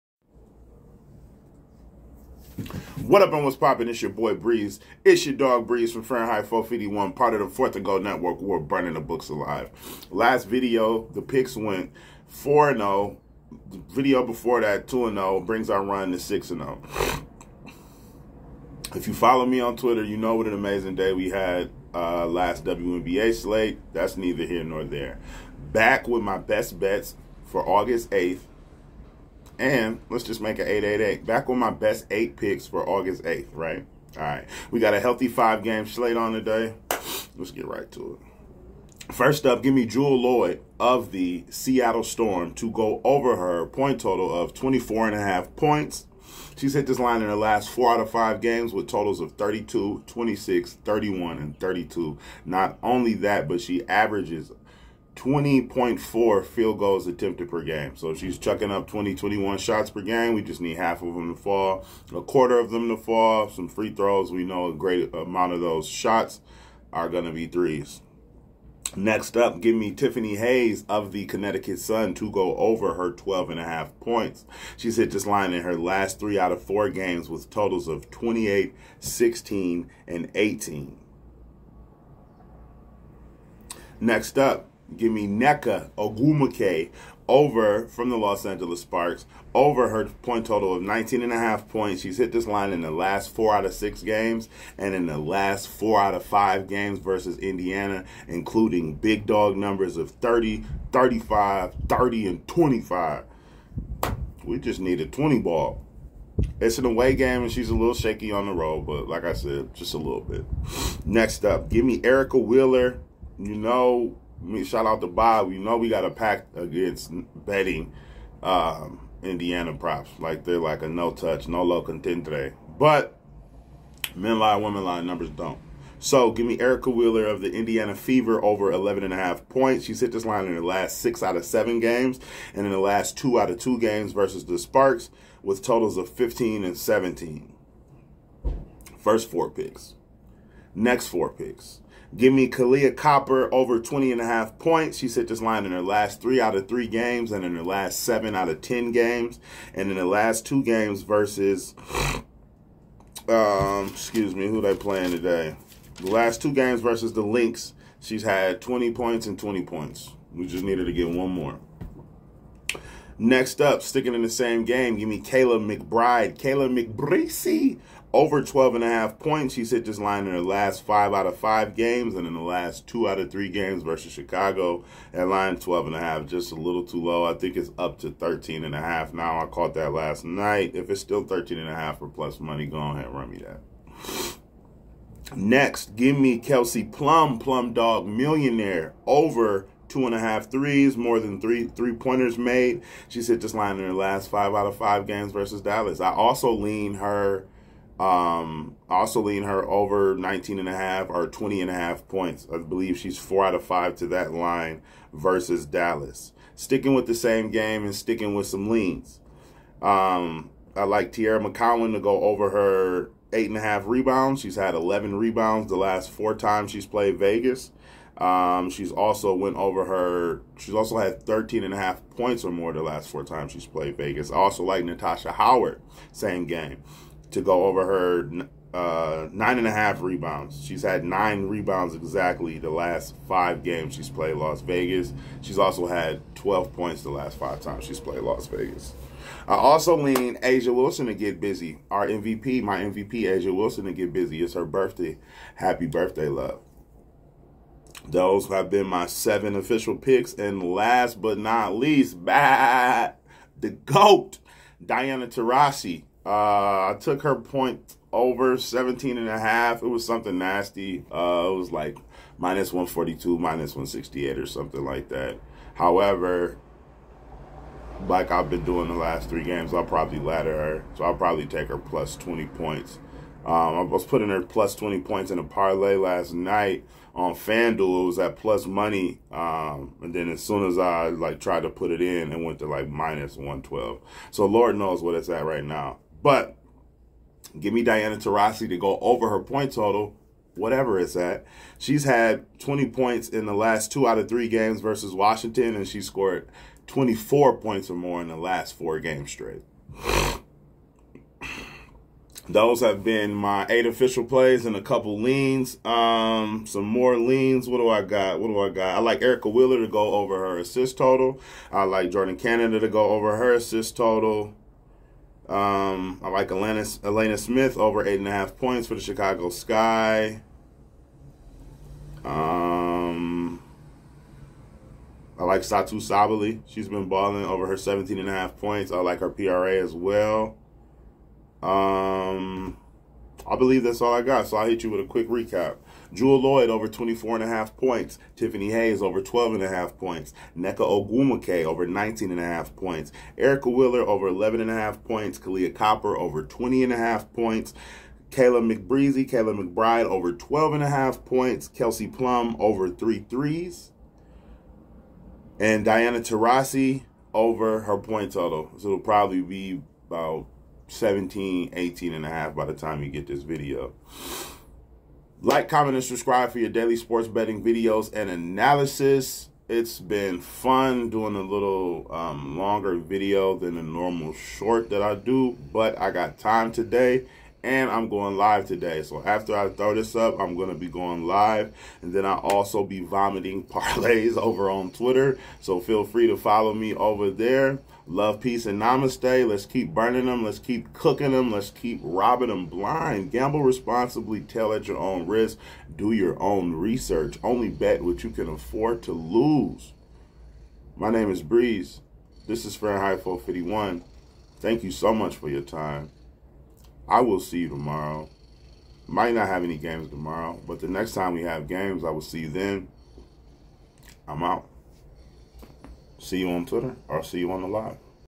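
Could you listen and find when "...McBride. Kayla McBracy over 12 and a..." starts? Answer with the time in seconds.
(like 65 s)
165 s.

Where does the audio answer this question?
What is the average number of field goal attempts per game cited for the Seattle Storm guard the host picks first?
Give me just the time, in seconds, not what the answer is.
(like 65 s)
55 s.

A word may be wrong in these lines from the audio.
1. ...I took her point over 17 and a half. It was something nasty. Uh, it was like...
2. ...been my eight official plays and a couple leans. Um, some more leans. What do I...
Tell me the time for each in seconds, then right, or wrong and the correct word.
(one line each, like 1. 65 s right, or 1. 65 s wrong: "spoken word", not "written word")
1. 256 s right
2. 303 s right.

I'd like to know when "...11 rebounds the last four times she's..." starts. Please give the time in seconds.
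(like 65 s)
214 s.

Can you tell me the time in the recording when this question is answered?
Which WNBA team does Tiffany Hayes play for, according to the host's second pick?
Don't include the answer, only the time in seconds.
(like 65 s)
71 s.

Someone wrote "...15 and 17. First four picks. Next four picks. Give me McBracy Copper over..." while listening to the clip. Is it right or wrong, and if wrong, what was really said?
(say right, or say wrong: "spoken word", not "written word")
wrong: "Kahleah", not "McBracy".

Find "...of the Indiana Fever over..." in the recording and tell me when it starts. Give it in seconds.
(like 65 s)
127 s.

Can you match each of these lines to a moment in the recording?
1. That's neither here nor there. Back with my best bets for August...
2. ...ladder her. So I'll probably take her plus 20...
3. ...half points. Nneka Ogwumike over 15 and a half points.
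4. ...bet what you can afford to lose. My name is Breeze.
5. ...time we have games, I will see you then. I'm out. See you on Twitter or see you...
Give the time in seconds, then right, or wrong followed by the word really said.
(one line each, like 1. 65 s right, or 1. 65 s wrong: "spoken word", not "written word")
1. 23 s right
2. 270 s right
3. 339 s wrong: "19", not "15"
4. 397 s right
5. 411 s right.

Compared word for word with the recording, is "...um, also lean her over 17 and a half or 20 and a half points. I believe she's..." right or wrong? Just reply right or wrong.
wrong.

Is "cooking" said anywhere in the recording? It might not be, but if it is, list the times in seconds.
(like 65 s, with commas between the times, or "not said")
390 s.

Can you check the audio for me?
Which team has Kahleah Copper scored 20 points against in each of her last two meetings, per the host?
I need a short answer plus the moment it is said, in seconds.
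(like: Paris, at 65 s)
Lynx, at 157 s.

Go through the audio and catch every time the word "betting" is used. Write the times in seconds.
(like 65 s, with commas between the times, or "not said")
117 s, 367 s.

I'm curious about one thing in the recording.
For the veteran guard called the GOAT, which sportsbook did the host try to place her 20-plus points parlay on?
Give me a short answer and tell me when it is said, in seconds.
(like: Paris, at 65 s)
FanDuel, at 277 s.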